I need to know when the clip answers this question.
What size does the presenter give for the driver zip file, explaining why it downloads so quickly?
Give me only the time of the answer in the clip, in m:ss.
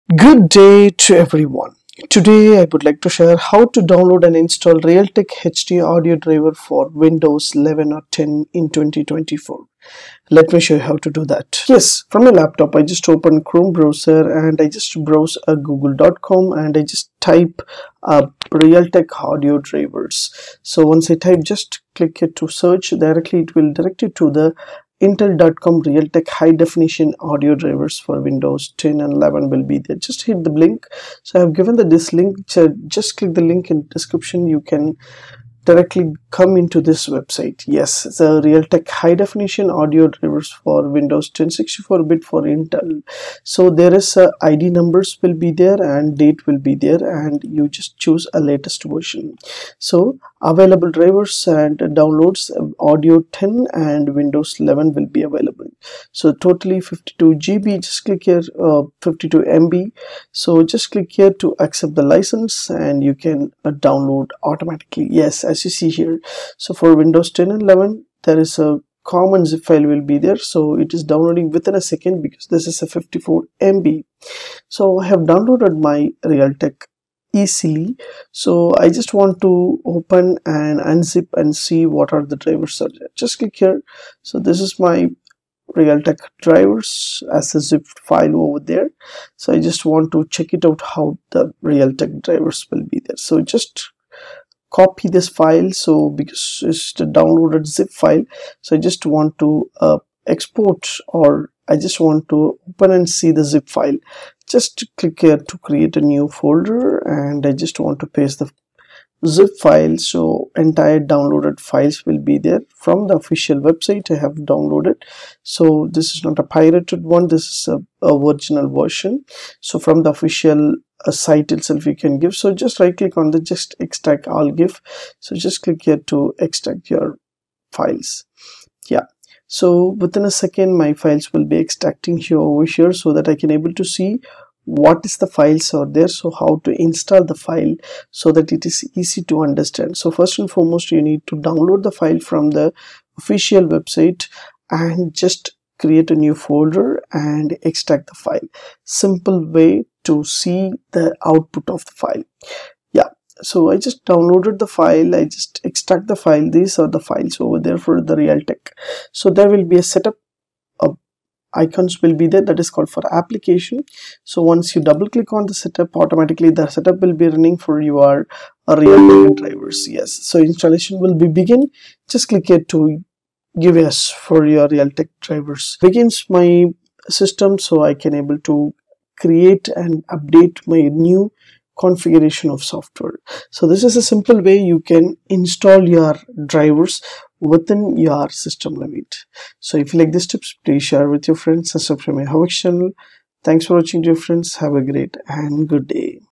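1:12.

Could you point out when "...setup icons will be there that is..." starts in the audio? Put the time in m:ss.
2:39.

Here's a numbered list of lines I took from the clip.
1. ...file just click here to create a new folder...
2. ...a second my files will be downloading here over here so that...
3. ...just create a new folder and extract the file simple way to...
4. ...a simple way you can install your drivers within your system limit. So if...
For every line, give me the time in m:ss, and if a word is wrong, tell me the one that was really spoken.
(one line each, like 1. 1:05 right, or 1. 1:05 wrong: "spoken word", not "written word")
1. 1:43 right
2. 2:10 wrong: "extracting", not "downloading"
3. 2:25 right
4. 3:03 right.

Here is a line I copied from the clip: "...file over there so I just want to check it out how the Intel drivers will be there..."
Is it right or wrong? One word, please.
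wrong.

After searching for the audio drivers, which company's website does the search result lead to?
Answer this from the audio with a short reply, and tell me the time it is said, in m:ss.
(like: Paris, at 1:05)
intel.com, at 0:25.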